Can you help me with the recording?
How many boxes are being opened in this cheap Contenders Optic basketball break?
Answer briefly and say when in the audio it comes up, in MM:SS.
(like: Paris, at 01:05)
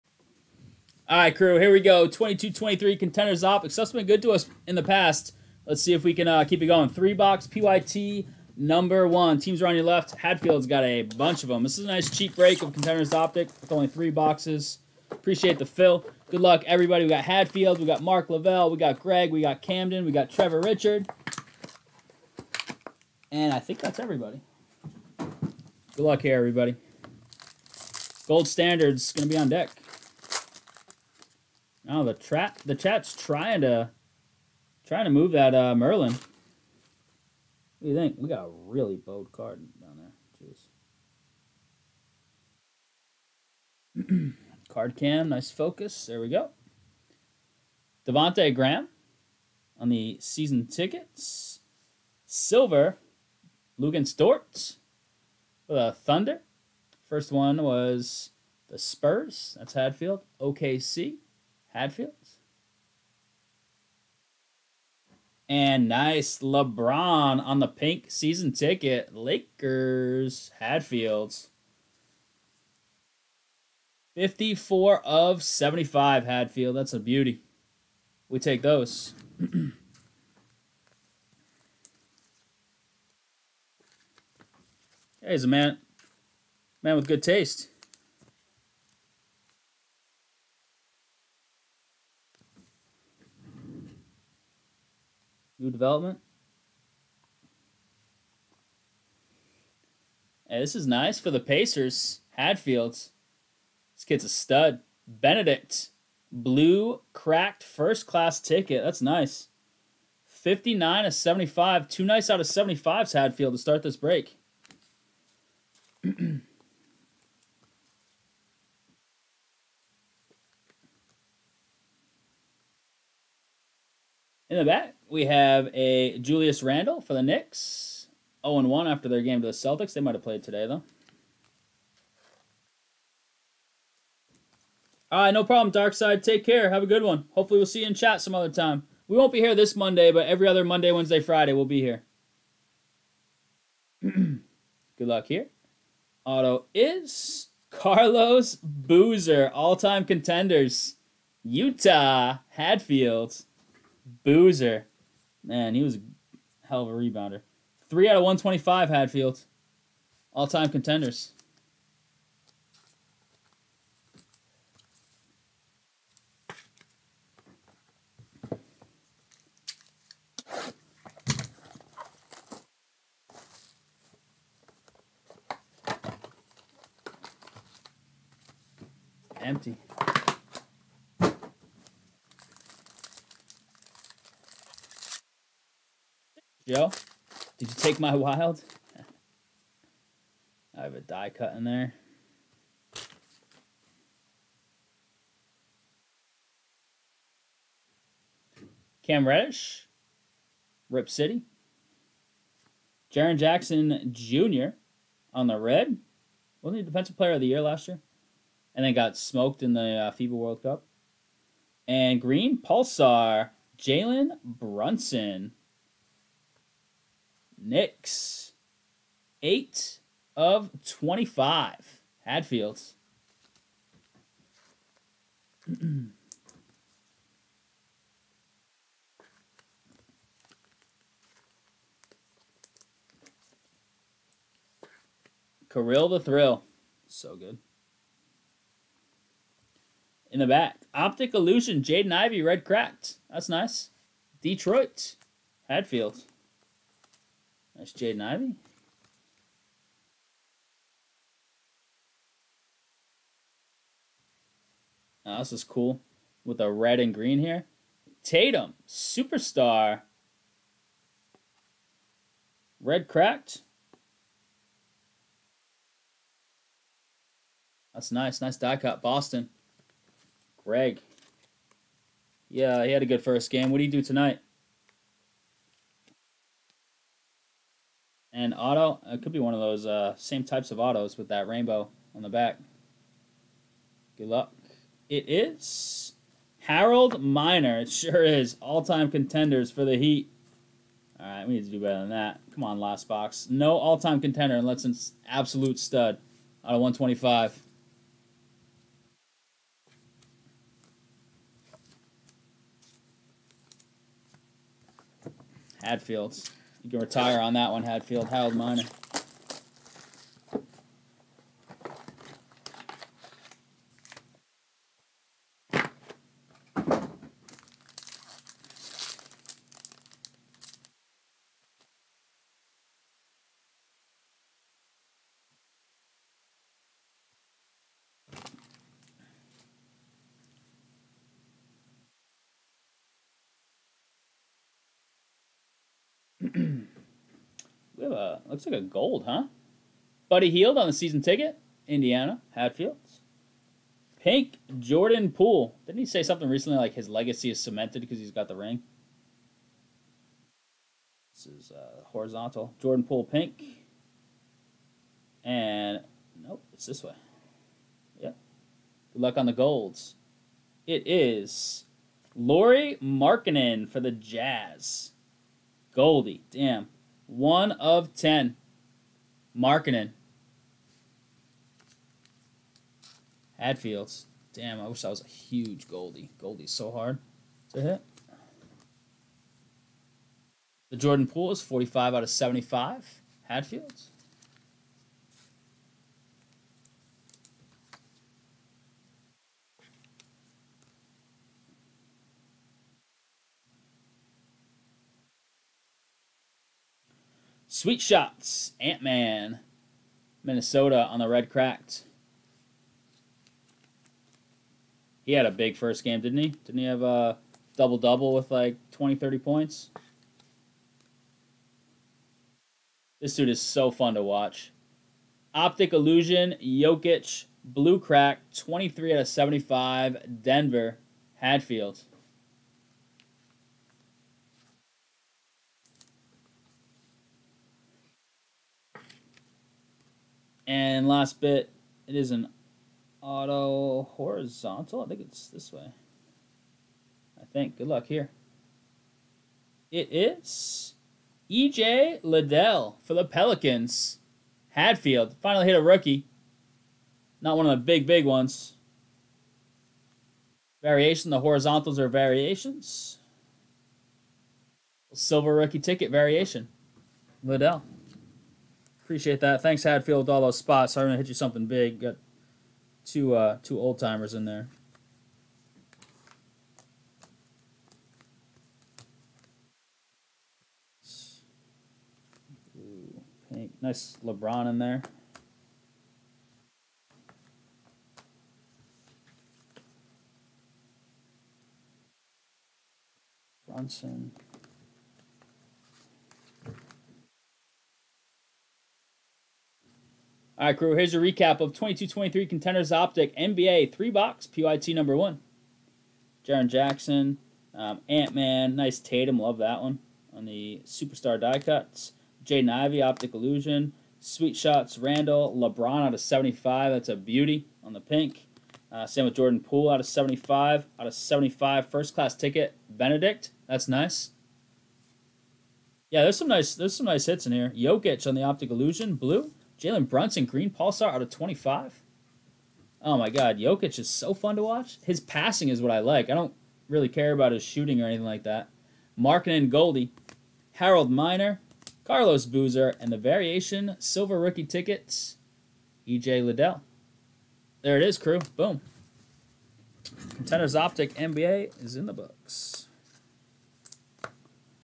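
3, at 00:13.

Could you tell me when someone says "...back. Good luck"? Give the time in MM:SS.
04:42.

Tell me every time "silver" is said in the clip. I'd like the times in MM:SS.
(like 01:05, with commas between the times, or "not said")
00:52, 07:35, 08:53.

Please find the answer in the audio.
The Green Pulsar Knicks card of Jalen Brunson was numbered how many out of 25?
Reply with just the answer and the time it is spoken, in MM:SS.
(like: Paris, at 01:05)
8, at 03:39.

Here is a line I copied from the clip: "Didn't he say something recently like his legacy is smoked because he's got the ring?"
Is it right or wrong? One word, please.
wrong.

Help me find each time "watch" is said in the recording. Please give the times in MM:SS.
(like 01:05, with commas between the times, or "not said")
06:54, 08:44.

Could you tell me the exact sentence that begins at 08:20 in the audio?
On the Superstar die cuts, Jaden Ivey, Optic Illusion, Sweet Shots, Randle, LeBron out of 75, that's a beauty on the pink.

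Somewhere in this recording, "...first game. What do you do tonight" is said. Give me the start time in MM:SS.
04:33.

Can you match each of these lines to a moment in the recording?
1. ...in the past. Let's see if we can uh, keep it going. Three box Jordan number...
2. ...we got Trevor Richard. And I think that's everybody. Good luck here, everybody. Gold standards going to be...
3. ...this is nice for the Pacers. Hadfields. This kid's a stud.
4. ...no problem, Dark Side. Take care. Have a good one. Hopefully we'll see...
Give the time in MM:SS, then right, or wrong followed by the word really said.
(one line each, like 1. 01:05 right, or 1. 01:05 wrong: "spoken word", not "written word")
1. 00:04 wrong: "PYT", not "Jordan"
2. 00:20 right
3. 01:40 right
4. 02:15 right.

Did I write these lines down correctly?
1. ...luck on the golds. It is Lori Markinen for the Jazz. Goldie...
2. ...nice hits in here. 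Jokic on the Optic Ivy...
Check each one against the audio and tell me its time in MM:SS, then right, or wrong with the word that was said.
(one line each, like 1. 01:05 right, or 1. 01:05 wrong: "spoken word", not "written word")
1. 05:59 right
2. 08:37 wrong: "Illusion", not "Ivy".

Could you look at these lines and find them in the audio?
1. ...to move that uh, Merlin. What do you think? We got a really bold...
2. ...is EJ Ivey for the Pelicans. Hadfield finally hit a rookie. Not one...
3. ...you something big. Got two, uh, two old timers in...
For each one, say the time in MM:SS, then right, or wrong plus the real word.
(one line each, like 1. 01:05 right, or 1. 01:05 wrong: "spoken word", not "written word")
1. 00:35 right
2. 07:20 wrong: "Liddell", not "Ivey"
3. 07:41 right.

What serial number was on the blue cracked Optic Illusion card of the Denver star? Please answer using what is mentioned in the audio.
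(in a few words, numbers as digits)
23 out of 75.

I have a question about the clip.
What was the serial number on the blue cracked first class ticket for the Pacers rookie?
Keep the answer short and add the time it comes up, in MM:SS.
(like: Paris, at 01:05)
59 of 75, at 01:50.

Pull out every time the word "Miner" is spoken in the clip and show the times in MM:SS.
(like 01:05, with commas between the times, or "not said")
04:47, 05:08, 08:51.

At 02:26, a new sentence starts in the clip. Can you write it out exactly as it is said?
Auto is Carlos Boozer, all-time contenders.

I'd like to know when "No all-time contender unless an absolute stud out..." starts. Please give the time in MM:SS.
04:53.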